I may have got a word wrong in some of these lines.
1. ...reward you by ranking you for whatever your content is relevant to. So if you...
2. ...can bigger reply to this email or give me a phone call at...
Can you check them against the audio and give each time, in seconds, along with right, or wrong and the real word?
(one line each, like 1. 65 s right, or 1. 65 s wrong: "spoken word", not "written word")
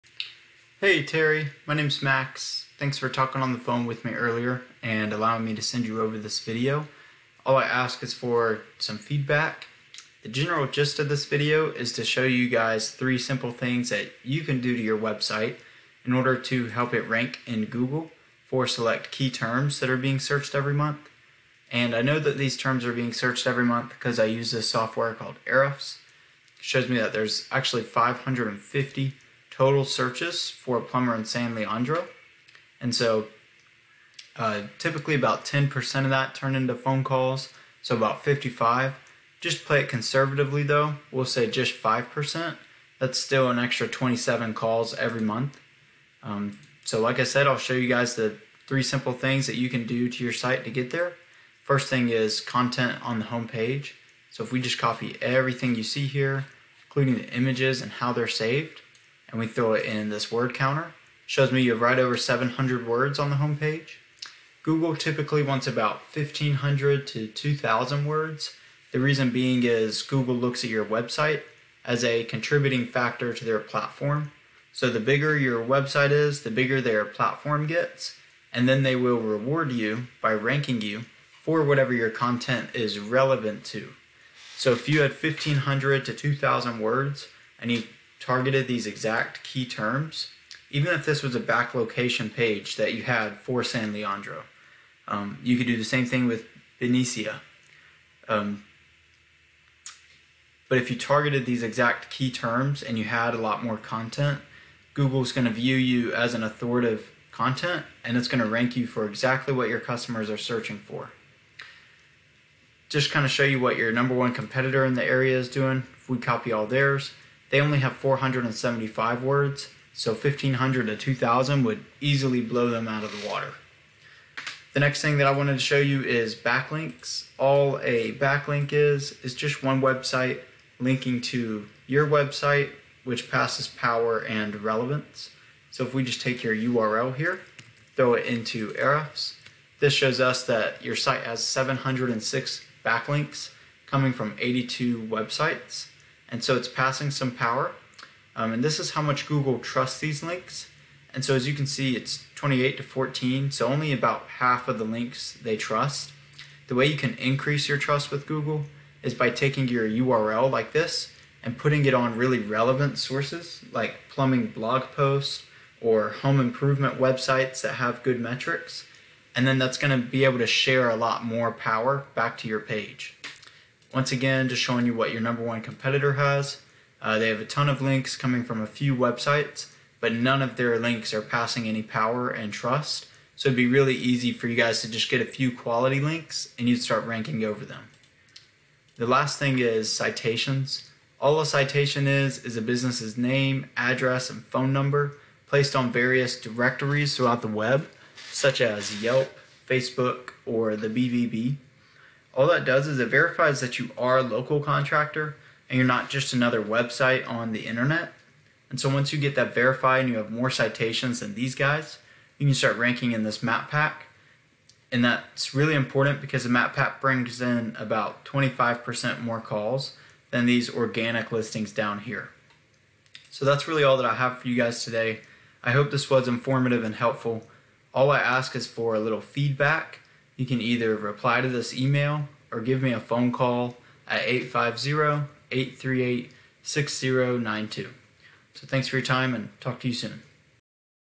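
1. 79 s right
2. 230 s wrong: "either", not "bigger".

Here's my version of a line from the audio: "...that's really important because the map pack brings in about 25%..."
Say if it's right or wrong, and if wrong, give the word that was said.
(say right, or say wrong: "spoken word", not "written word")
right.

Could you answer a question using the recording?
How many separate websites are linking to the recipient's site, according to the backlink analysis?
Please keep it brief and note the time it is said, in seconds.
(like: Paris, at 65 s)
82, at 144 s.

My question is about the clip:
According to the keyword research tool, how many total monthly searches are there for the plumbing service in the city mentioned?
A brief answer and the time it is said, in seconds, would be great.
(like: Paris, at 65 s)
550, at 27 s.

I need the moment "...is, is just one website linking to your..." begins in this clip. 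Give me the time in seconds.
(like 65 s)
128 s.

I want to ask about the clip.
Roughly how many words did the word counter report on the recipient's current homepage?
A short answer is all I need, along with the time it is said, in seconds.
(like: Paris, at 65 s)
700, at 62 s.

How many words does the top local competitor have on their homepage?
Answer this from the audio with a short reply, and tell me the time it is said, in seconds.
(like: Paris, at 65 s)
475, at 117 s.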